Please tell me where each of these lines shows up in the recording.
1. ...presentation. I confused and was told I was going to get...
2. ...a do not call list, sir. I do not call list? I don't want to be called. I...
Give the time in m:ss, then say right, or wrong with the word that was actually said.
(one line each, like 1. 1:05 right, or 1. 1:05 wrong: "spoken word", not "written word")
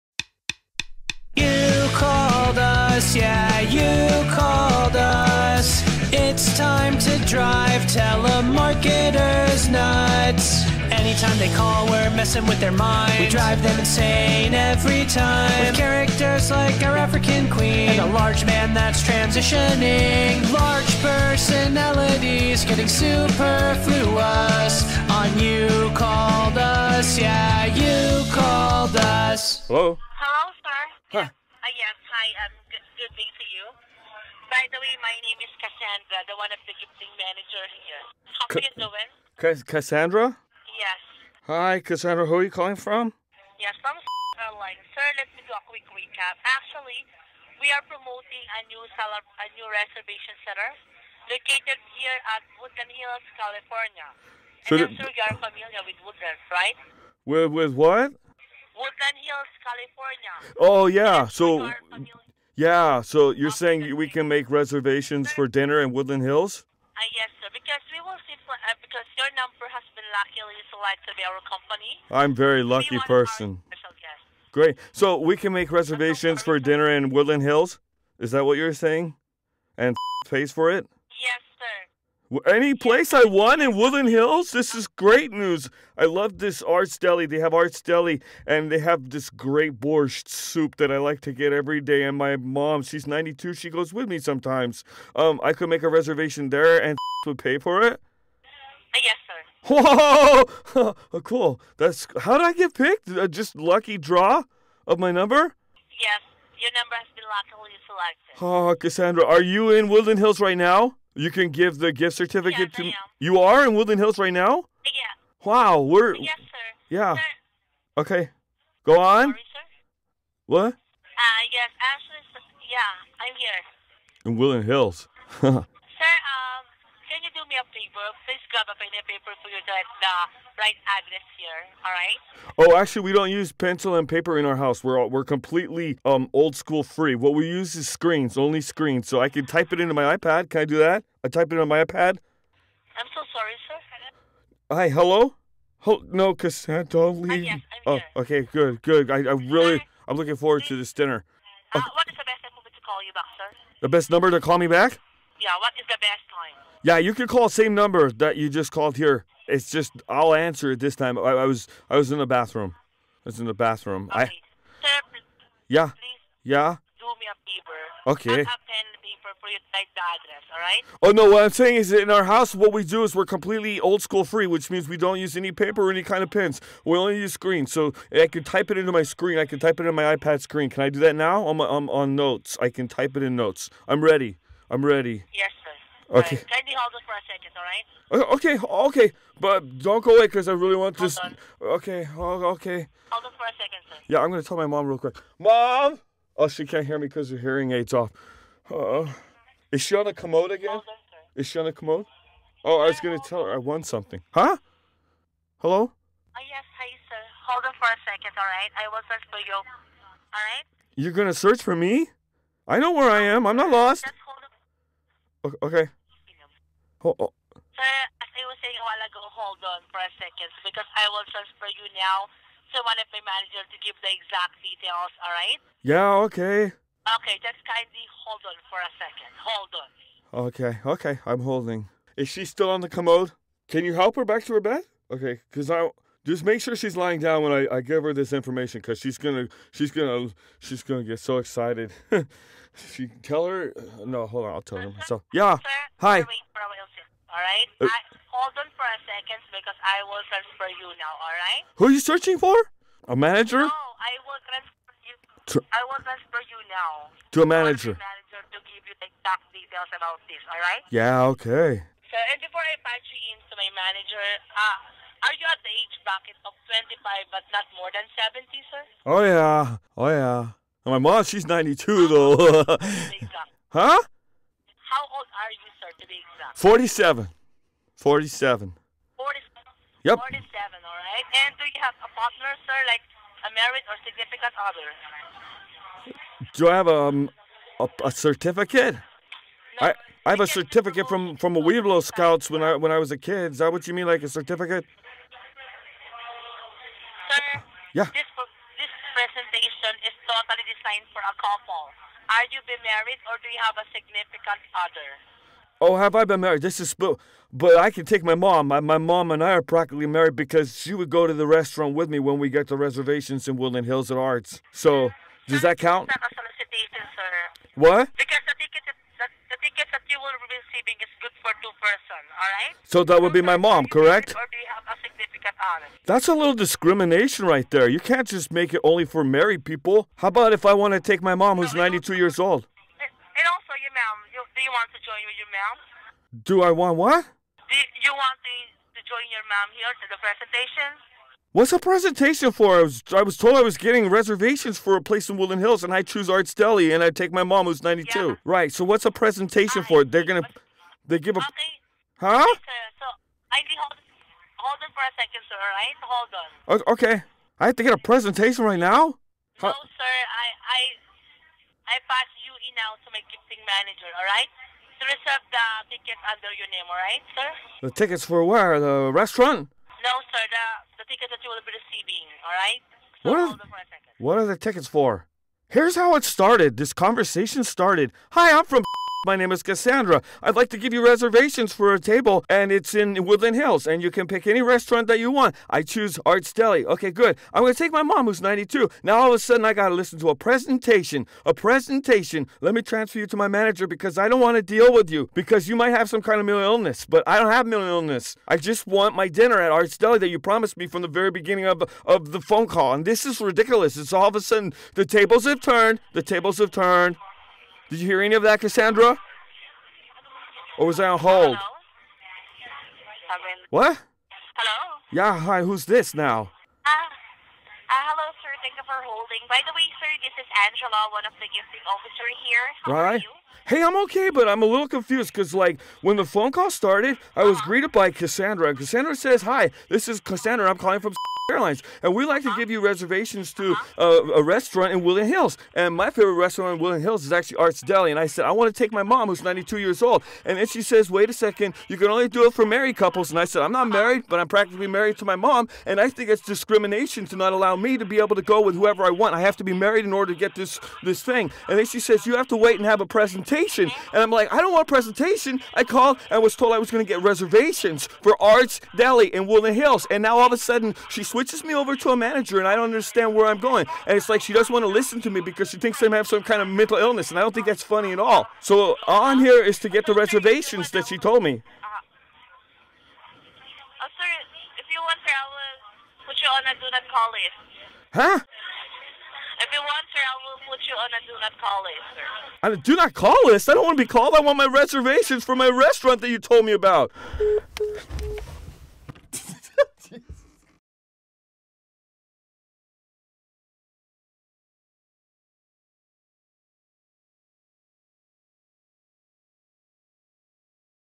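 1. 7:34 wrong: "called", not "confused"
2. 8:01 right.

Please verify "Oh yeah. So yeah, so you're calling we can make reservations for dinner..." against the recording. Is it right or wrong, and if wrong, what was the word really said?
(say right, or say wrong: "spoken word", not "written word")
wrong: "saying", not "calling".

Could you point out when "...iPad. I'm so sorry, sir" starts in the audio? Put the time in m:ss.
2:21.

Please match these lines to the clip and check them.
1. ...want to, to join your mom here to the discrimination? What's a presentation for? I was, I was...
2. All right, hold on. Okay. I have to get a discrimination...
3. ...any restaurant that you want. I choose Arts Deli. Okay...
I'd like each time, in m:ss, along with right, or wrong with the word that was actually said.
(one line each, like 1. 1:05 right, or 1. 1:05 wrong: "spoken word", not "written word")
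1. 5:38 wrong: "presentation", not "discrimination"
2. 5:56 wrong: "presentation", not "discrimination"
3. 6:24 right.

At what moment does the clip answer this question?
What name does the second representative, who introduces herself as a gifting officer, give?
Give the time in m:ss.
7:00.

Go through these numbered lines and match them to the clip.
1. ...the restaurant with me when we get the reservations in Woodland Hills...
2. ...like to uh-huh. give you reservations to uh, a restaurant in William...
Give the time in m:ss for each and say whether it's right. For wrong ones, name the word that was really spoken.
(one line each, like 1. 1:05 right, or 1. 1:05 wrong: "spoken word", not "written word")
1. 5:11 right
2. 7:12 right.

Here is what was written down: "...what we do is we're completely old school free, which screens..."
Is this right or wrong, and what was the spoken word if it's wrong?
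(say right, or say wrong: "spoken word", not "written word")
wrong: "means", not "screens".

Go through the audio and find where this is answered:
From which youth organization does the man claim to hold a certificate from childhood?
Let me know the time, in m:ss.
4:51.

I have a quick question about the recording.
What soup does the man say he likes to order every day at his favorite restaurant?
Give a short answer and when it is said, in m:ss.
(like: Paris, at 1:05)
borscht, at 1:29.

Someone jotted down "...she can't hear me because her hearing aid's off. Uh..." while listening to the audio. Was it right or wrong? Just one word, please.
right.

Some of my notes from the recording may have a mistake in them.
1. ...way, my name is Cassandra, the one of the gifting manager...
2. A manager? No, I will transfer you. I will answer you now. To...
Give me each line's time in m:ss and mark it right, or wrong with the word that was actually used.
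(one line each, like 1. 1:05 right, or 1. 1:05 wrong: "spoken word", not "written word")
1. 0:34 right
2. 4:13 wrong: "transfer", not "answer".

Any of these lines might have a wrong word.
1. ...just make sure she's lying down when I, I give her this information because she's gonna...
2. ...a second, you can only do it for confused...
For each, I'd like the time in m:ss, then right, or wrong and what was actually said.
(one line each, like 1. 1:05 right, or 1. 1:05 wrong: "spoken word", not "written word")
1. 3:56 right
2. 7:21 wrong: "married", not "confused".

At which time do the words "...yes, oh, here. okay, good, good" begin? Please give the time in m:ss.
2:27.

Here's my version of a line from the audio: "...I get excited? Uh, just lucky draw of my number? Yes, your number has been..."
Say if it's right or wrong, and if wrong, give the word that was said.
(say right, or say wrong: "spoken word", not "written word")
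wrong: "picked", not "excited".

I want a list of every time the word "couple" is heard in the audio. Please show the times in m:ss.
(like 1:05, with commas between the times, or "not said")
5:01, 7:22.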